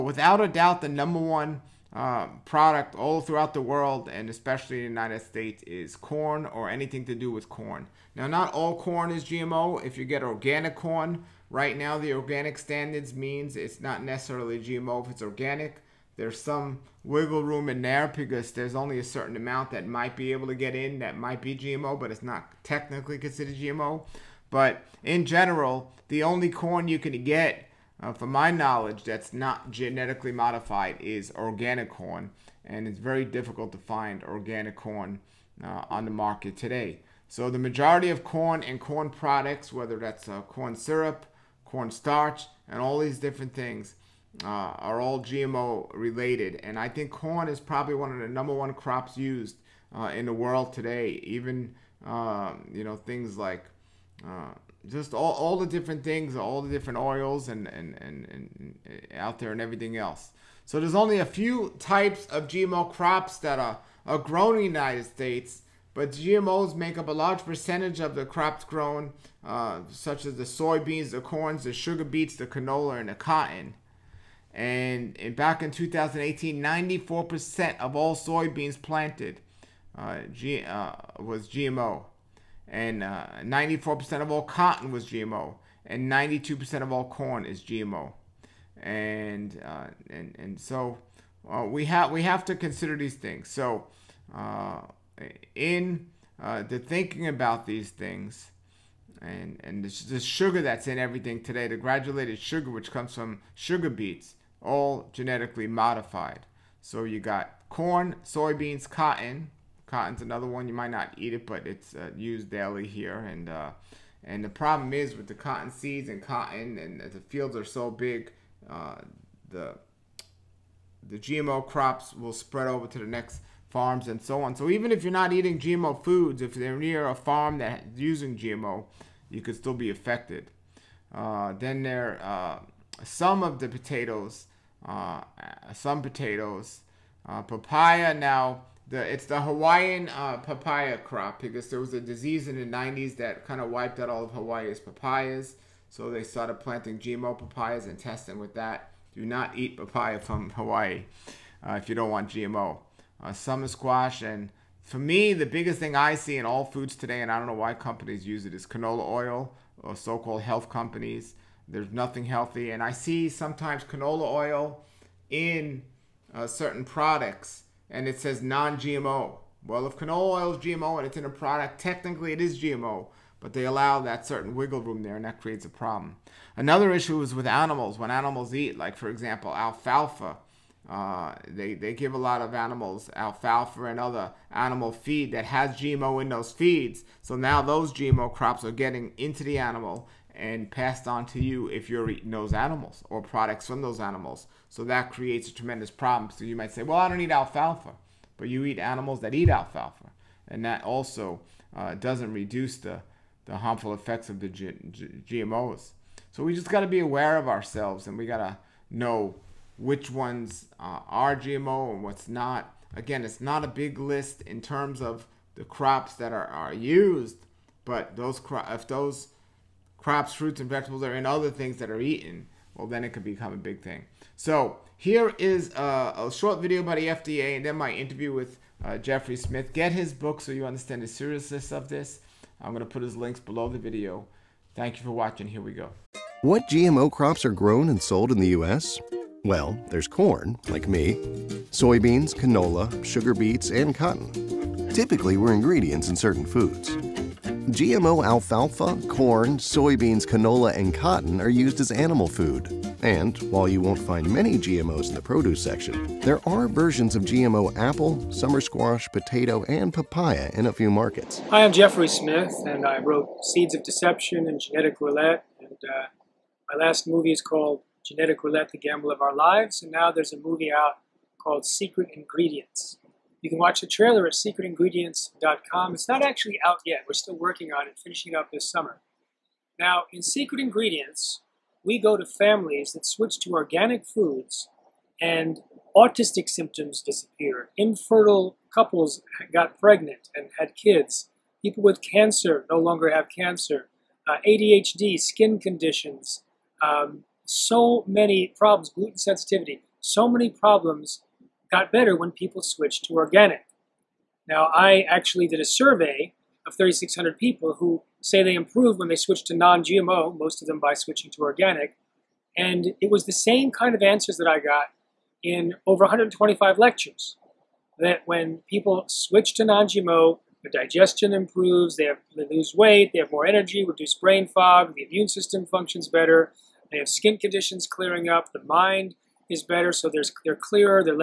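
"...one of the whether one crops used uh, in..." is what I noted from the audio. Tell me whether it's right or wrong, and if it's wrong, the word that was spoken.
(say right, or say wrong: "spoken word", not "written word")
wrong: "number", not "whether".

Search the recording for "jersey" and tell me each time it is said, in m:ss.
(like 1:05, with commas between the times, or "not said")
not said.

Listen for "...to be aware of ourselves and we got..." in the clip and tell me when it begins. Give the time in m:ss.
3:26.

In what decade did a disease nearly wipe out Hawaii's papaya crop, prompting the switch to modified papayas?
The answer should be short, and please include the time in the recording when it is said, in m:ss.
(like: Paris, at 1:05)
the 90s, at 2:22.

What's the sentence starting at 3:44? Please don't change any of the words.
So here is a, a short video by the FDA and then my interview with uh, Jeffrey Smith.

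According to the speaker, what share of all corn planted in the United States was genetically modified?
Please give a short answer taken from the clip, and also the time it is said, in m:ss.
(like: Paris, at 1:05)
92%, at 1:26.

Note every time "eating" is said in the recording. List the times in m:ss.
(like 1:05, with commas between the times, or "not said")
2:05, 3:12.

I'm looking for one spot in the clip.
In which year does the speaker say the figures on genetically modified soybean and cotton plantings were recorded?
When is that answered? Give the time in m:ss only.
1:15.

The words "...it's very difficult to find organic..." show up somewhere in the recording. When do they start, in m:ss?
0:32.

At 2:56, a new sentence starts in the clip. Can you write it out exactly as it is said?
Another issue is with animals, when animals eat, like for example, alfalfa.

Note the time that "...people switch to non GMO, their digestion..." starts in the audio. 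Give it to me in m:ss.
5:18.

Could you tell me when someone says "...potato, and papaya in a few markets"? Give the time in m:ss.
4:19.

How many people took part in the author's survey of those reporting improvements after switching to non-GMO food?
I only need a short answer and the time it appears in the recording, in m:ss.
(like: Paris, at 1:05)
3,600, at 5:06.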